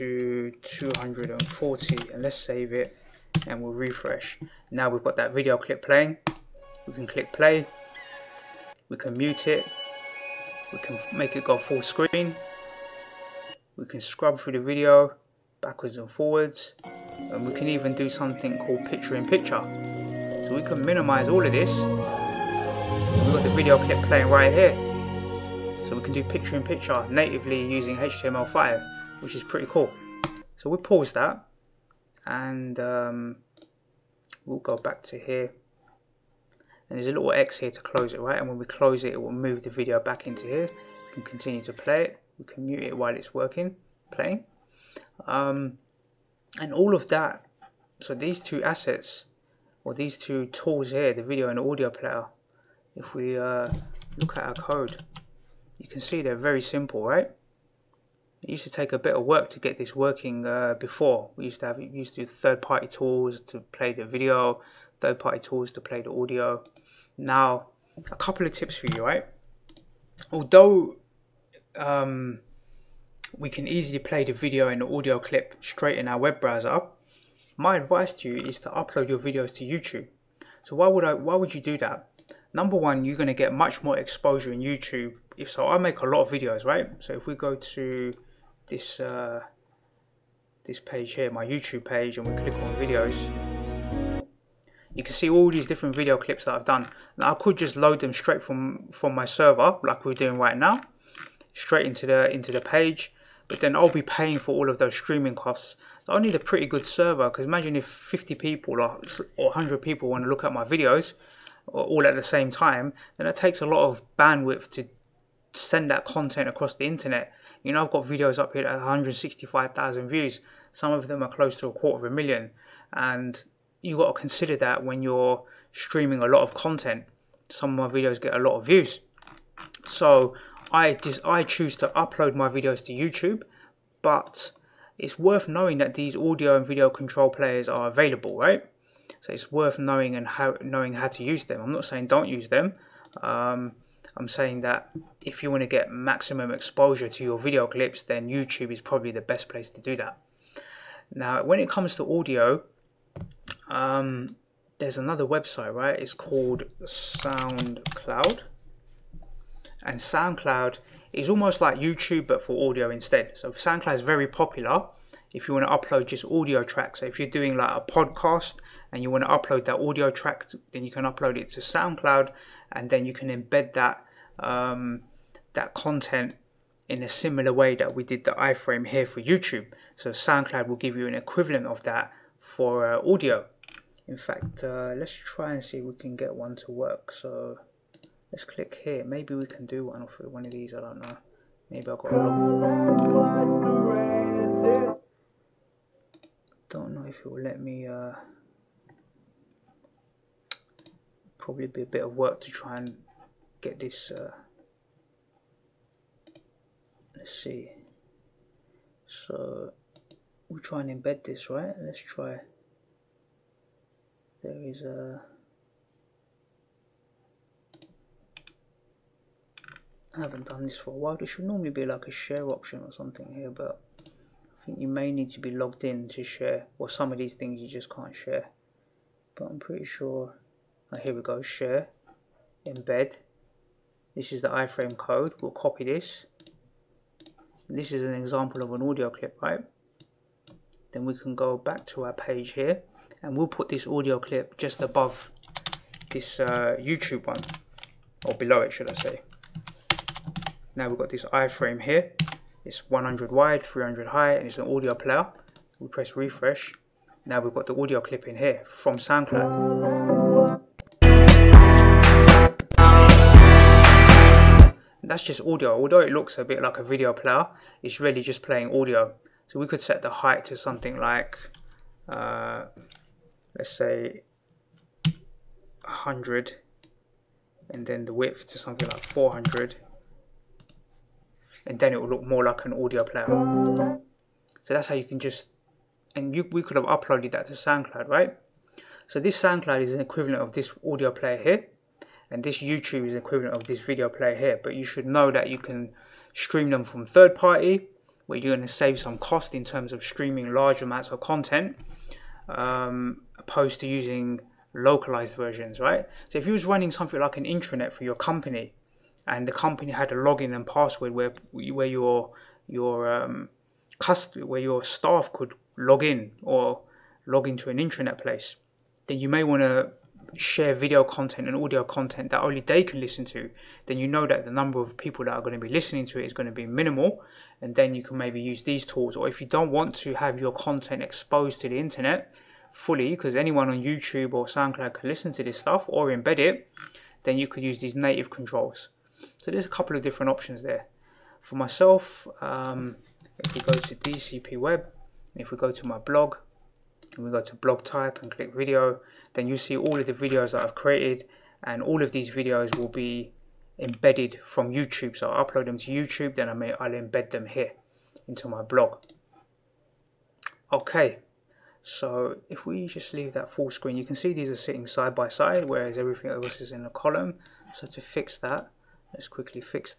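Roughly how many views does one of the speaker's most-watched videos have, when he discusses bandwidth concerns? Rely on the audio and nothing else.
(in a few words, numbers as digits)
165,000.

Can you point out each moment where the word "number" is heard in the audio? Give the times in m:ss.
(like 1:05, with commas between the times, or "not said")
1:22, 5:24.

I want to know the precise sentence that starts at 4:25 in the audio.
Although it looks a bit like a video player, it's really just playing audio.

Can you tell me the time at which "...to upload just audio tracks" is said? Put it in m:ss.
2:45.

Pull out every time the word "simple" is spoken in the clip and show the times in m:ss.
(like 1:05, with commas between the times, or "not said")
0:56.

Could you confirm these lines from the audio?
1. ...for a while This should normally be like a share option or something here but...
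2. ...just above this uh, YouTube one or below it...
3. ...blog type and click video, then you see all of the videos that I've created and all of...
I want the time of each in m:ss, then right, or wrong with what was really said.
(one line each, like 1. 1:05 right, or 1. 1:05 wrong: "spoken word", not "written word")
1. 3:40 right
2. 4:04 right
3. 5:47 right.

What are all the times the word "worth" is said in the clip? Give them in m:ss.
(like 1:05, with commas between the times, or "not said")
2:15, 2:19.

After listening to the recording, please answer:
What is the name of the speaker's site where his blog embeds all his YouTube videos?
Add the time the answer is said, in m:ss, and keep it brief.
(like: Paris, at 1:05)
DCP Web, at 5:43.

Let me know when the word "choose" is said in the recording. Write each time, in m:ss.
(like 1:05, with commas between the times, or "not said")
2:11.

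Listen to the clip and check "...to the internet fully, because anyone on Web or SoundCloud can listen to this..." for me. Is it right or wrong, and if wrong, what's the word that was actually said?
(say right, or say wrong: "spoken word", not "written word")
wrong: "YouTube", not "Web".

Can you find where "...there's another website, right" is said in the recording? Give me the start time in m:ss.
2:34.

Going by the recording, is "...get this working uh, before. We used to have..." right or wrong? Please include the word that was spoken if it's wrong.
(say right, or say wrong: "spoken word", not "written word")
right.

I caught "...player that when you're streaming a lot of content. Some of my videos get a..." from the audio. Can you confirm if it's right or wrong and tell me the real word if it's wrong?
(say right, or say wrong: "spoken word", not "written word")
wrong: "consider", not "player".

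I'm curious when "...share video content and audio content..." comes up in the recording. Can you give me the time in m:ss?
5:20.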